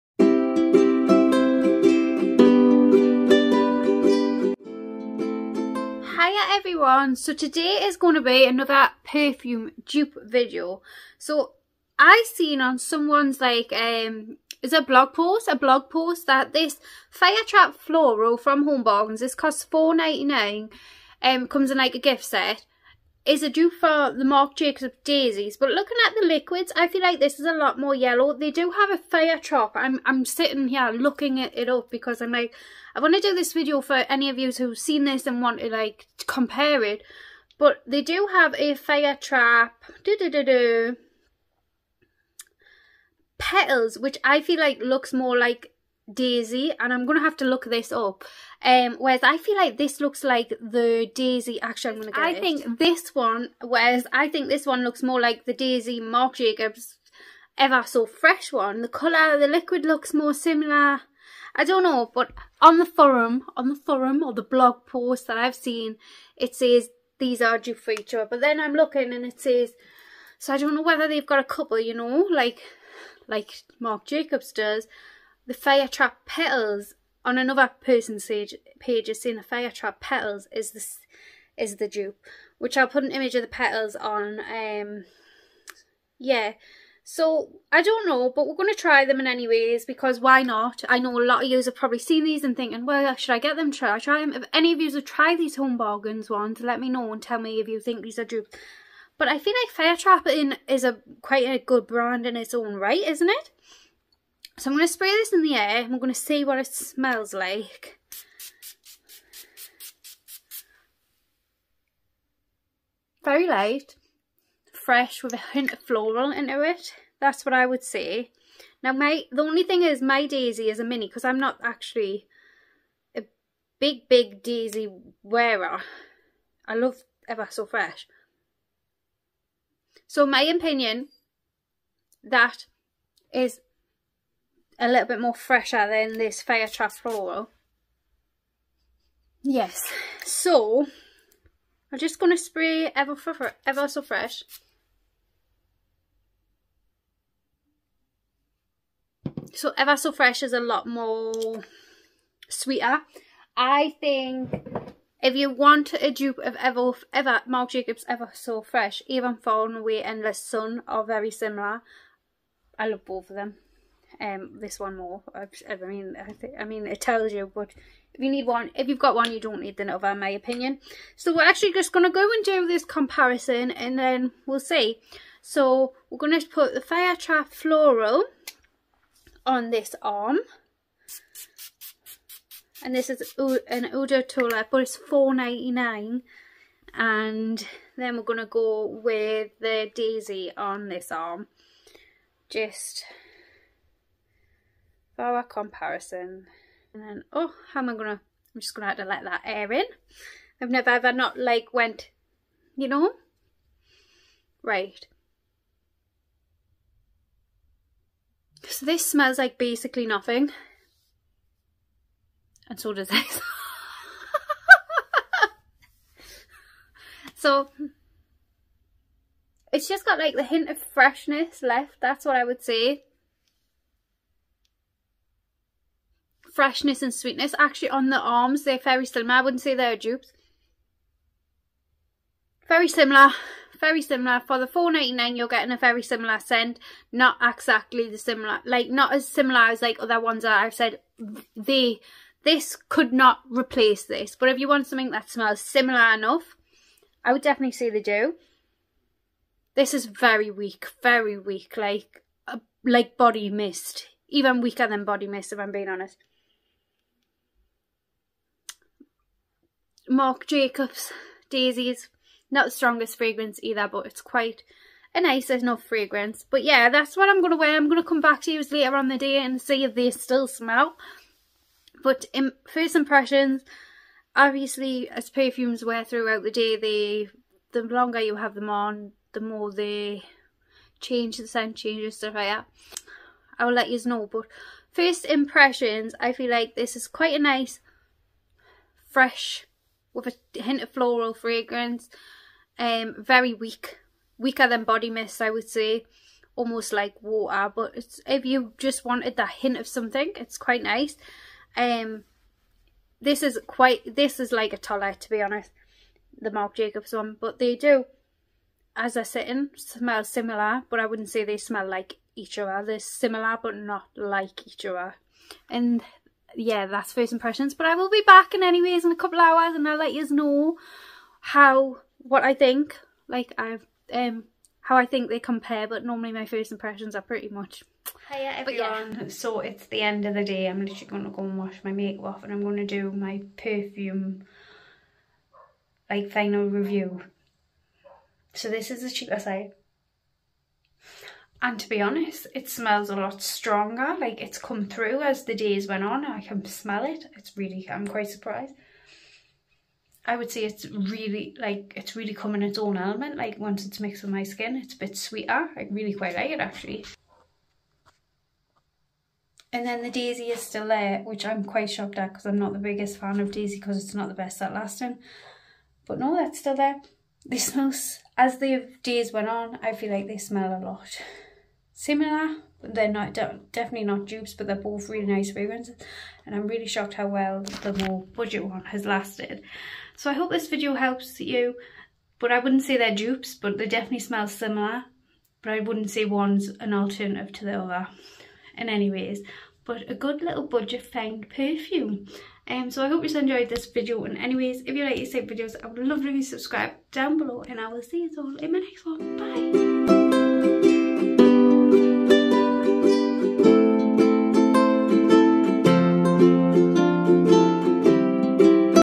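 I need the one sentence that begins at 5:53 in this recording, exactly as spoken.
Like once it's mixed with my skin, it's a bit sweeter.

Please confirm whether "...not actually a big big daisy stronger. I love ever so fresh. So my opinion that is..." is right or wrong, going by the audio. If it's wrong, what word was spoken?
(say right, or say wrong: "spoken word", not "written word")
wrong: "wearer", not "stronger".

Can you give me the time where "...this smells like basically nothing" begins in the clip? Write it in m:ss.
3:28.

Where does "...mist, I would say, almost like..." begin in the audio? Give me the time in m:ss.
4:55.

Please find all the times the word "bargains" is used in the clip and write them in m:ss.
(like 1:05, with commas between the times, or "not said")
0:18, 1:35.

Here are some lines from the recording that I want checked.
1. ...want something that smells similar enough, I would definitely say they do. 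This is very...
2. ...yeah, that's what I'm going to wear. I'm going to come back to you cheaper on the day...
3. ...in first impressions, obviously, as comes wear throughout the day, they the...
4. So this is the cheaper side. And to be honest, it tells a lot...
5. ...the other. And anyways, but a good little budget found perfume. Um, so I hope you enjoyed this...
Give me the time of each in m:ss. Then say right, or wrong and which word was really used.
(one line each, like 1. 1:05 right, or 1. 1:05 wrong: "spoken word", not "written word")
1. 4:04 right
2. 4:26 wrong: "later", not "cheaper"
3. 4:32 wrong: "perfumes", not "comes"
4. 5:38 wrong: "smells", not "tells"
5. 6:27 right.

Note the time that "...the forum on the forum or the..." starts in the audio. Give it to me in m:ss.
1:02.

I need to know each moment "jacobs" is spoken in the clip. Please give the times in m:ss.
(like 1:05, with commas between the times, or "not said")
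0:24, 0:56, 1:14, 2:37, 4:20, 5:06.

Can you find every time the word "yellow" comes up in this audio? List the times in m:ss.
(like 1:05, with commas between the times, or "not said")
0:27.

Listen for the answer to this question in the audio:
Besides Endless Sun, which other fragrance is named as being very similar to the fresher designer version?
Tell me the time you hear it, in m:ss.
2:39.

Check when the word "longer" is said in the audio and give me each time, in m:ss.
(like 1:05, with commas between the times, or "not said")
4:37.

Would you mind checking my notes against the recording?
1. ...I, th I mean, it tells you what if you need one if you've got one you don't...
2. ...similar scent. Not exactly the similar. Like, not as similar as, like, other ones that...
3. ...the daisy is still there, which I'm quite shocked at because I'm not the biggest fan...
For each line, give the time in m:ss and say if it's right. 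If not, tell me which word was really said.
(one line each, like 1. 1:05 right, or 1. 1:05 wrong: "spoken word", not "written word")
1. 2:46 right
2. 3:56 right
3. 6:00 right.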